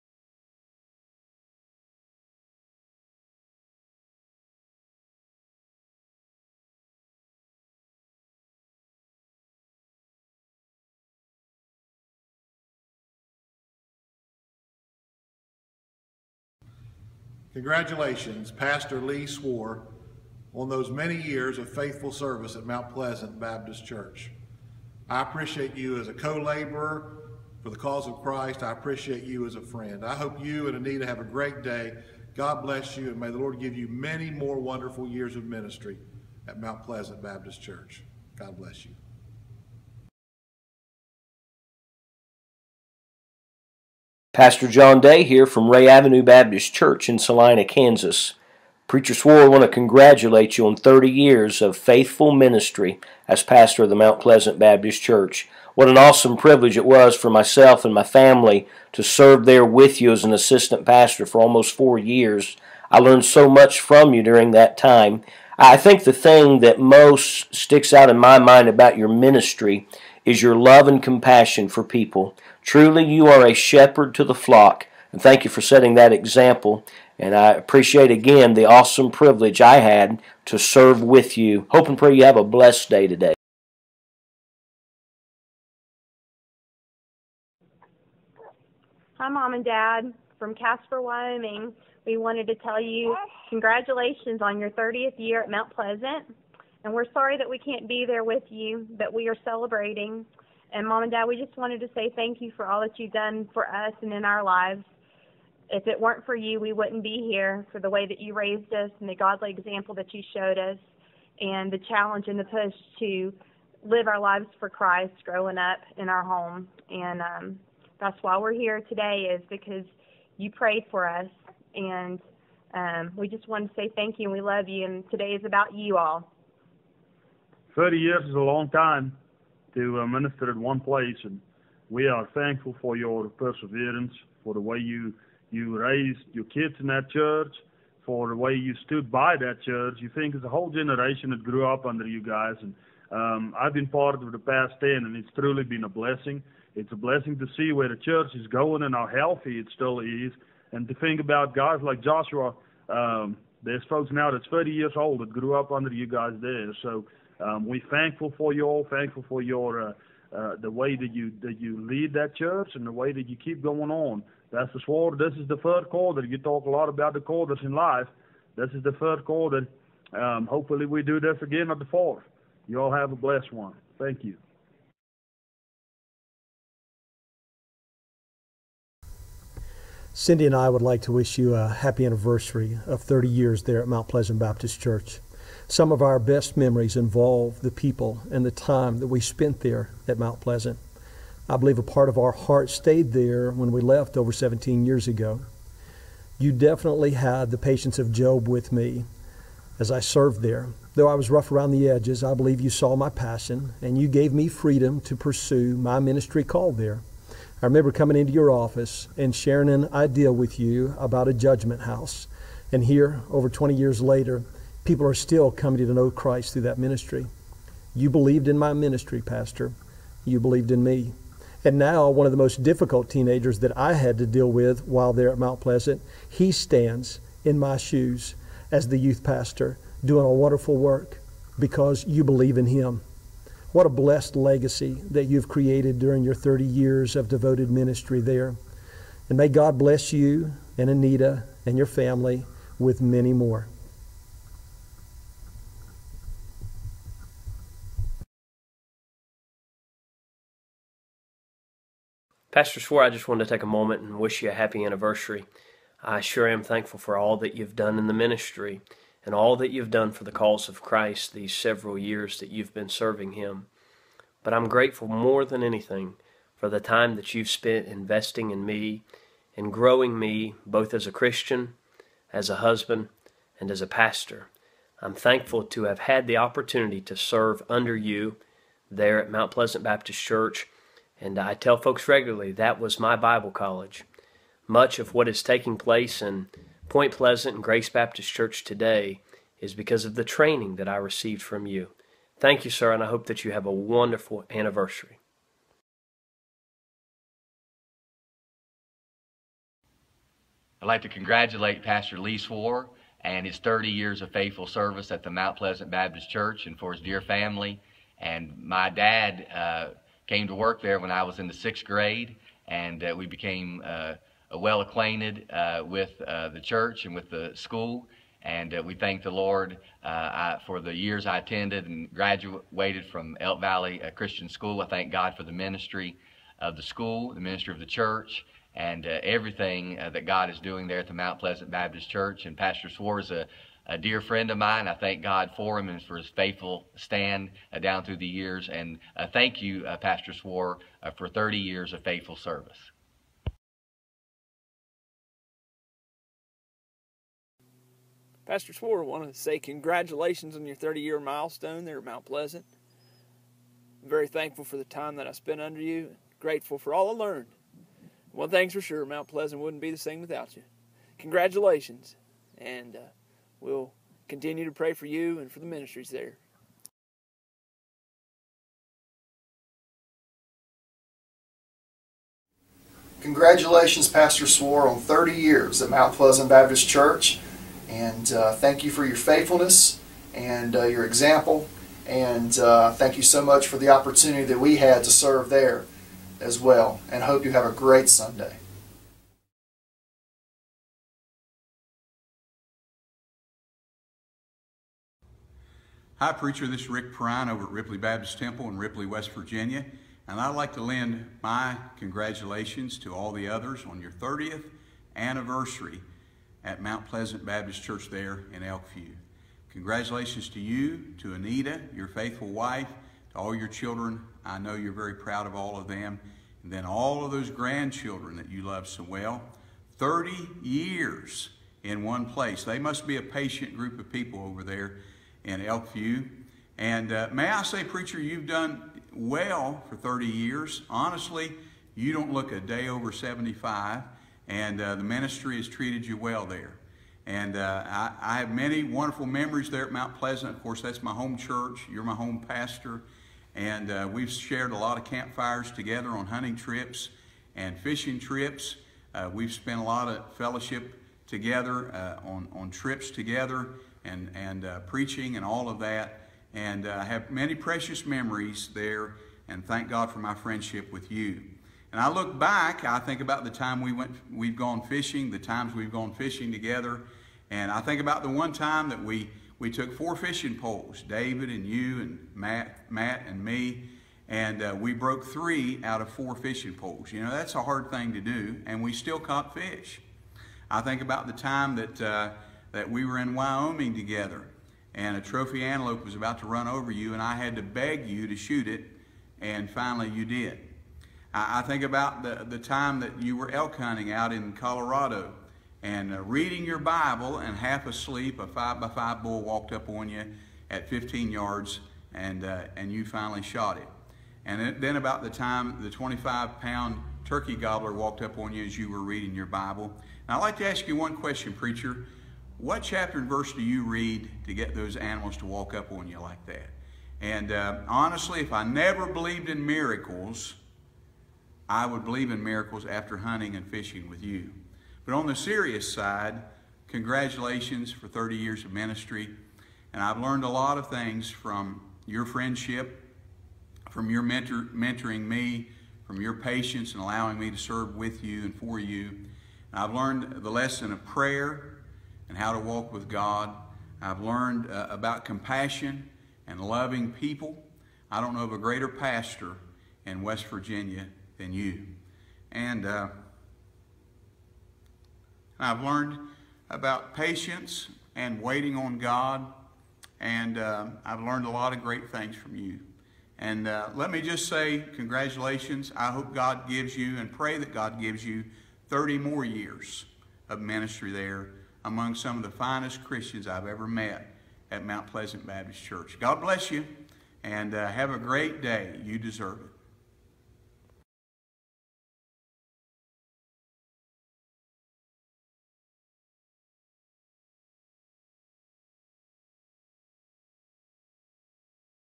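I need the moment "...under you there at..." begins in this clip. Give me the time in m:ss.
4:37.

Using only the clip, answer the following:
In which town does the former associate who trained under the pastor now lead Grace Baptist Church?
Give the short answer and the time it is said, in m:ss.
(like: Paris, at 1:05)
Point Pleasant, at 4:46.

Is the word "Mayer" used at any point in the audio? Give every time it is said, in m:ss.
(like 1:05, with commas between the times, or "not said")
not said.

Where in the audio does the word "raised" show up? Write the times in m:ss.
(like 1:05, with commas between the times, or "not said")
1:48, 2:15.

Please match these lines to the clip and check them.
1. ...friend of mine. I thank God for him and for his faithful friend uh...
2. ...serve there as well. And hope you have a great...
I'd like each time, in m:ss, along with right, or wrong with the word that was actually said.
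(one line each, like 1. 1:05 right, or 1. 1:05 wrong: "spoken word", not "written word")
1. 5:34 wrong: "stand", not "friend"
2. 6:25 right.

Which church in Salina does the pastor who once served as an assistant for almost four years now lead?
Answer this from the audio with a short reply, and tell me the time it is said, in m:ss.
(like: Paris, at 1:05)
Ray Avenue Baptist Church, at 0:45.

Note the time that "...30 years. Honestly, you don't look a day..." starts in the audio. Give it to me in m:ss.
7:09.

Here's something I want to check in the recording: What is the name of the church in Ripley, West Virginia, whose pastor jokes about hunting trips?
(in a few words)
Ripley Baptist Temple.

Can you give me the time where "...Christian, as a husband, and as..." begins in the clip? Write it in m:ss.
4:31.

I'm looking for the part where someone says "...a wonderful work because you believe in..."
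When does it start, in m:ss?
3:50.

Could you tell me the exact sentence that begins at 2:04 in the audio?
And today is about you all.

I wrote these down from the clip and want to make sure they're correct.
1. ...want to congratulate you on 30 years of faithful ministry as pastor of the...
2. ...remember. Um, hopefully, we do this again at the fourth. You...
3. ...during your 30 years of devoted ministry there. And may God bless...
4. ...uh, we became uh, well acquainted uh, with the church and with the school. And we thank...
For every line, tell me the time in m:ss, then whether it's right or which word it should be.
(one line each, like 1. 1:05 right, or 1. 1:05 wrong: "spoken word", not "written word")
1. 0:49 right
2. 2:49 wrong: "quarter", not "remember"
3. 3:55 right
4. 5:13 right.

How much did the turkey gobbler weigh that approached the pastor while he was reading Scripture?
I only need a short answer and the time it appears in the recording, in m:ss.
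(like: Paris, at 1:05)
25 pounds, at 8:25.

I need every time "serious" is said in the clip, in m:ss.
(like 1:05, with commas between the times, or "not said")
8:45.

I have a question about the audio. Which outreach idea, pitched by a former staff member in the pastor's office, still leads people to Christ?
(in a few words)
judgment house.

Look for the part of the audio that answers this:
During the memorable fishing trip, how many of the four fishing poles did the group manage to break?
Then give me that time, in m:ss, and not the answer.
7:55.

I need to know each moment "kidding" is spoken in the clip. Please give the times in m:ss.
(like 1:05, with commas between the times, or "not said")
not said.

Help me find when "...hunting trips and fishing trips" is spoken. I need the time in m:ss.
7:26.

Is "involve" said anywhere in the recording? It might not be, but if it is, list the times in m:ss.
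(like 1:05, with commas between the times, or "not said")
3:06.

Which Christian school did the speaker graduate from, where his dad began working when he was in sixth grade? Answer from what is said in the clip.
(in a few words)
Elk Valley Christian School.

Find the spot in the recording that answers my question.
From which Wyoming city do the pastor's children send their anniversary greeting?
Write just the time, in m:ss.
1:30.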